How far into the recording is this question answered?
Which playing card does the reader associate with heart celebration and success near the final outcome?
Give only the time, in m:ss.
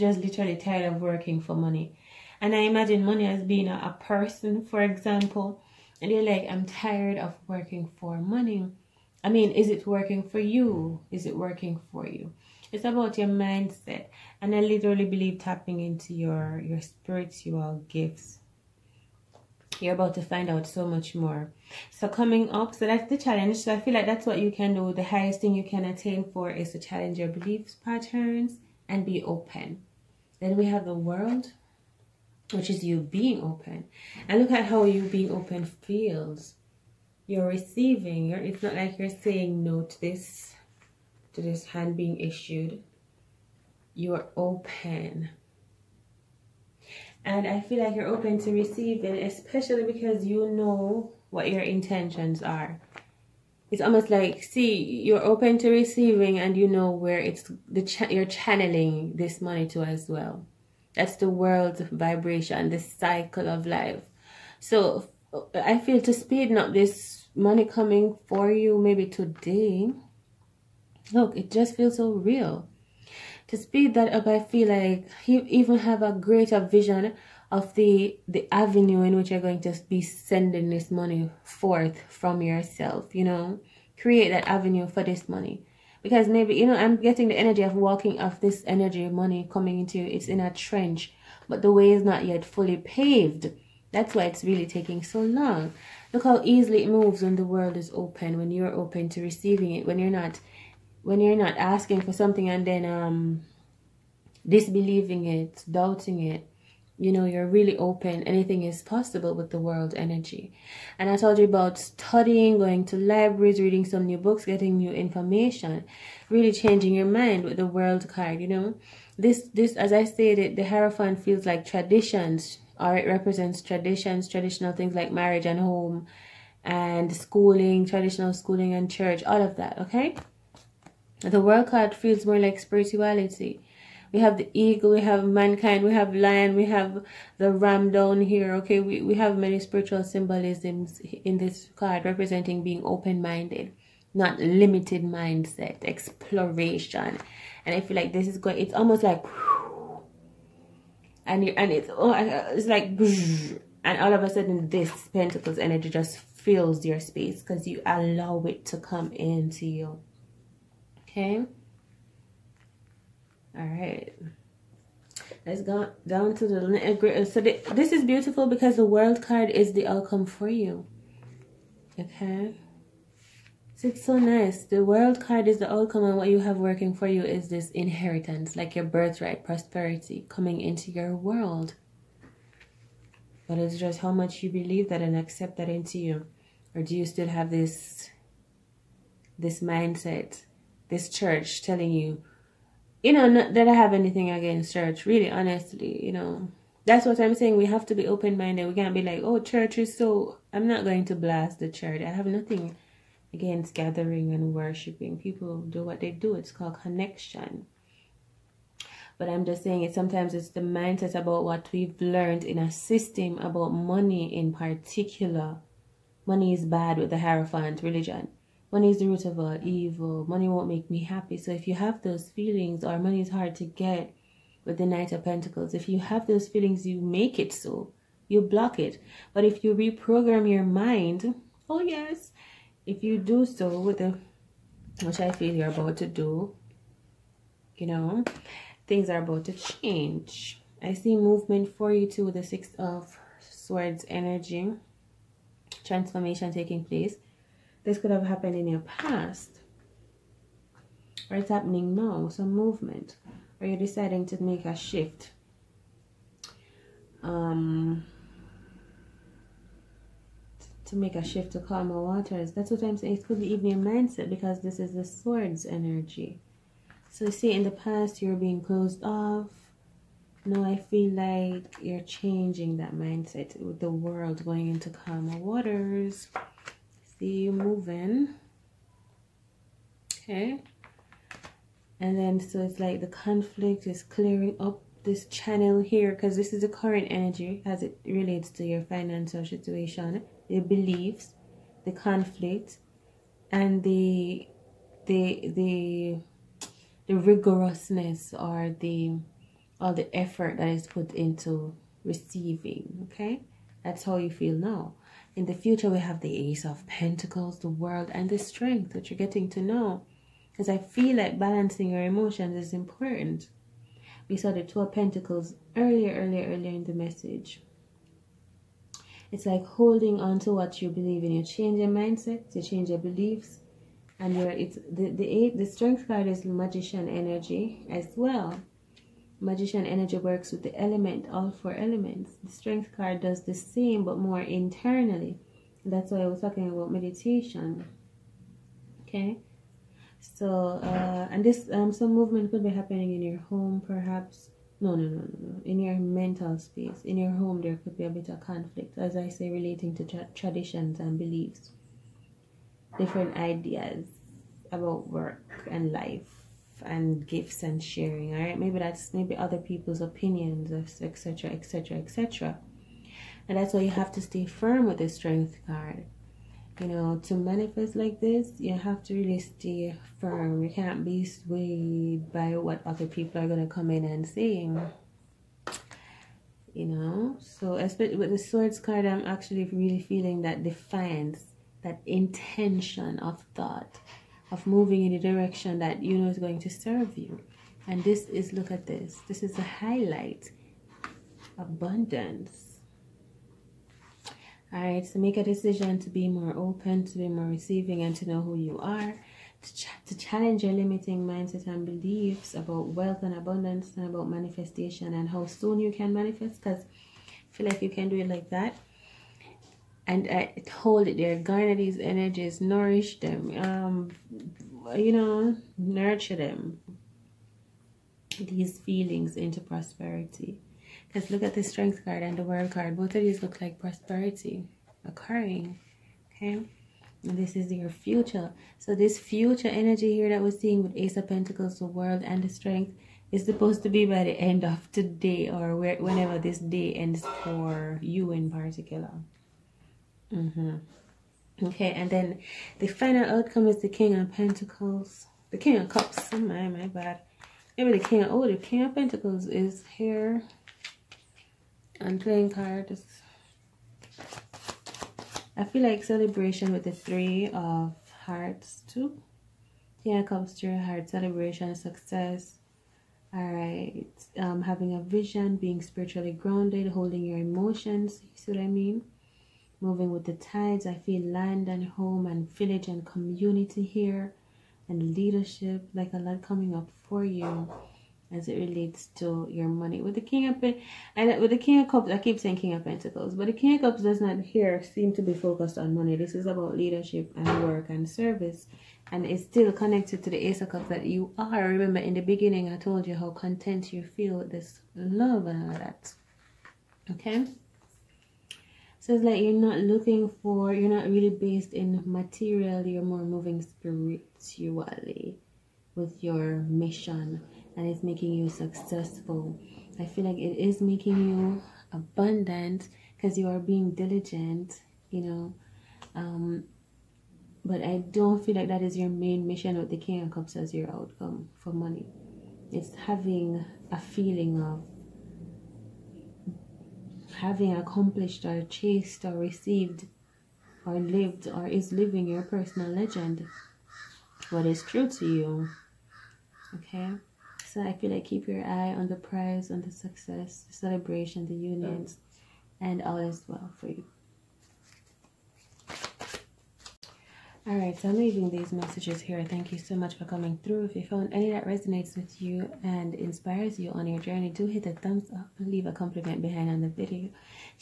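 7:36.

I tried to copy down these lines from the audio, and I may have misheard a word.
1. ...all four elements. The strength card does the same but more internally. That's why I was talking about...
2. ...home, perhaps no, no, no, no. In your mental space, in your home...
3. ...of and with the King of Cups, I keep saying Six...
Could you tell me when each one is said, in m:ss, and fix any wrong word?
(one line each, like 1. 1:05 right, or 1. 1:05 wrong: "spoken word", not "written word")
1. 5:31 right
2. 5:43 right
3. 8:00 wrong: "King", not "Six".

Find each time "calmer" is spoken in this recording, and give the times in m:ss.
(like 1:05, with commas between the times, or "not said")
4:21, 4:34.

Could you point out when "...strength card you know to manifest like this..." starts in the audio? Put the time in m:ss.
6:05.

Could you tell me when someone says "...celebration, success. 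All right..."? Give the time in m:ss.
7:41.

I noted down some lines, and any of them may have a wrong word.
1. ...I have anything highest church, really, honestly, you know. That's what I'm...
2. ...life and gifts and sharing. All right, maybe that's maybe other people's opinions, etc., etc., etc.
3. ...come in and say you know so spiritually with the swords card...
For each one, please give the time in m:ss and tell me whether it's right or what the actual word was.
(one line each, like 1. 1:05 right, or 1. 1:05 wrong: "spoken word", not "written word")
1. 3:13 wrong: "against", not "highest"
2. 5:55 right
3. 6:13 wrong: "especially", not "spiritually".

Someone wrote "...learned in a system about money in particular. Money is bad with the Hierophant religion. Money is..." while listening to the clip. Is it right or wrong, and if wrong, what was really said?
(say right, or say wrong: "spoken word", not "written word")
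right.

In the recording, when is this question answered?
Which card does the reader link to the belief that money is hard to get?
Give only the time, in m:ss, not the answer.
3:44.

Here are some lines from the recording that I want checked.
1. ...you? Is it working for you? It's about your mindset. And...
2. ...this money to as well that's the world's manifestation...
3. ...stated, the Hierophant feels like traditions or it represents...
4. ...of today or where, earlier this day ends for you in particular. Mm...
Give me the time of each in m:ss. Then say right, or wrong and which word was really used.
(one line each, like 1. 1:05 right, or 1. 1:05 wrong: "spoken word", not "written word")
1. 0:10 right
2. 0:59 wrong: "vibration", not "manifestation"
3. 2:00 right
4. 7:14 wrong: "whenever", not "earlier".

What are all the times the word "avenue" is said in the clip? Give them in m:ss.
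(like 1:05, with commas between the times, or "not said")
1:18, 1:24.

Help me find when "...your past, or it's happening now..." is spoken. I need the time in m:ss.
4:08.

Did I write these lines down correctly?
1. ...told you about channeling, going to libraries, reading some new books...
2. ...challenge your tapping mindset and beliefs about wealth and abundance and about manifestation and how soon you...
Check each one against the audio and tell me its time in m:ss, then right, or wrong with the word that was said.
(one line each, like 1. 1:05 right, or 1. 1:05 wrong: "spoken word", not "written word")
1. 1:51 wrong: "studying", not "channeling"
2. 6:40 wrong: "limiting", not "tapping".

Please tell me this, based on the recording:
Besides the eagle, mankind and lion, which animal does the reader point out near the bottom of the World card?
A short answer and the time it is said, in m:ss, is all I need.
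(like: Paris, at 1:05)
ram, at 2:17.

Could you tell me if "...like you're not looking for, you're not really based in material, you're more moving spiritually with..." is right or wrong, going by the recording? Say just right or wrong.
right.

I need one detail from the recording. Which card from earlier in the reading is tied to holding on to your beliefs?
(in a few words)
Two of Pentacles.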